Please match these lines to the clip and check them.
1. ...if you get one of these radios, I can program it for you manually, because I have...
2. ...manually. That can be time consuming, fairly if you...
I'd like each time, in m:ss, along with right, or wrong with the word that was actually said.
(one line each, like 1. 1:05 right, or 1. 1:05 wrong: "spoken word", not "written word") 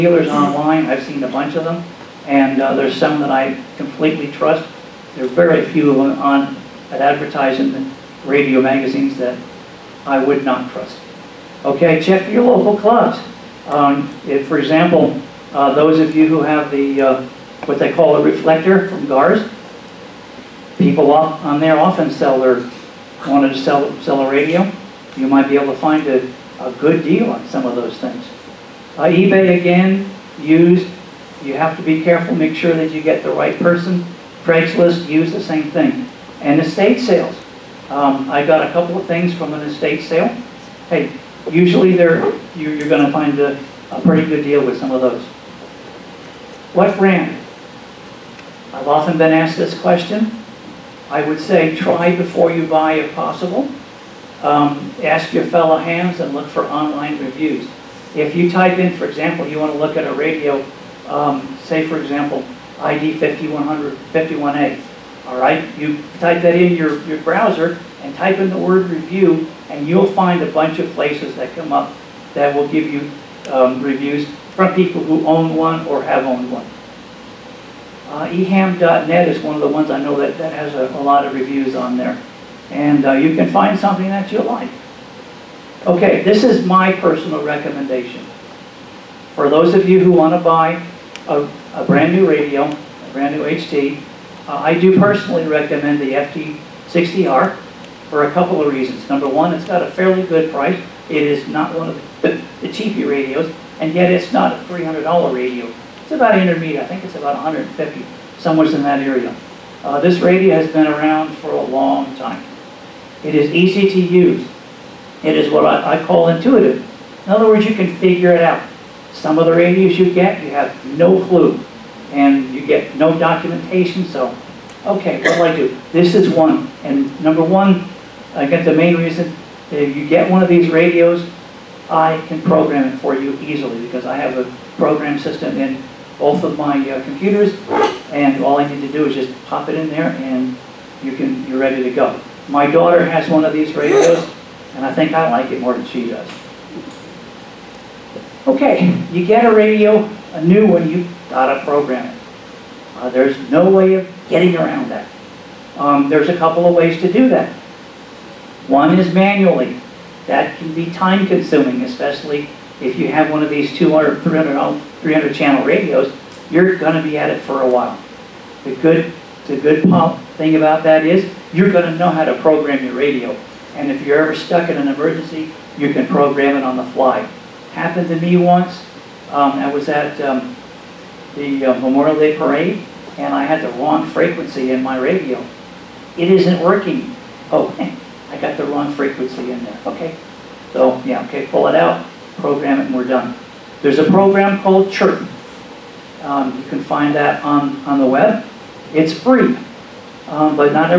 1. 2:09 wrong: "easily", not "manually"
2. 2:39 wrong: "especially", not "fairly".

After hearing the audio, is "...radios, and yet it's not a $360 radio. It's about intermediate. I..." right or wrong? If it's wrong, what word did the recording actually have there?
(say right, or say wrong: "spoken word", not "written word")
wrong: "300", not "360".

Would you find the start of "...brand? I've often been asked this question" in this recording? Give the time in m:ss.
0:46.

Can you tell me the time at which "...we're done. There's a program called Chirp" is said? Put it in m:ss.
3:12.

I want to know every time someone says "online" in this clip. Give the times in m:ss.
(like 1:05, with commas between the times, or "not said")
0:00, 0:56.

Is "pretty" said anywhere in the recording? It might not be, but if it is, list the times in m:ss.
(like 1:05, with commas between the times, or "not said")
0:44.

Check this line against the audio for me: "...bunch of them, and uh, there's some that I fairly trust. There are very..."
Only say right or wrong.
wrong.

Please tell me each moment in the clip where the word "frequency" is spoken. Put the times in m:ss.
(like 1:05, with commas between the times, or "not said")
3:04, 3:08.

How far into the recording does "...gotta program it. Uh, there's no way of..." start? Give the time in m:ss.
2:31.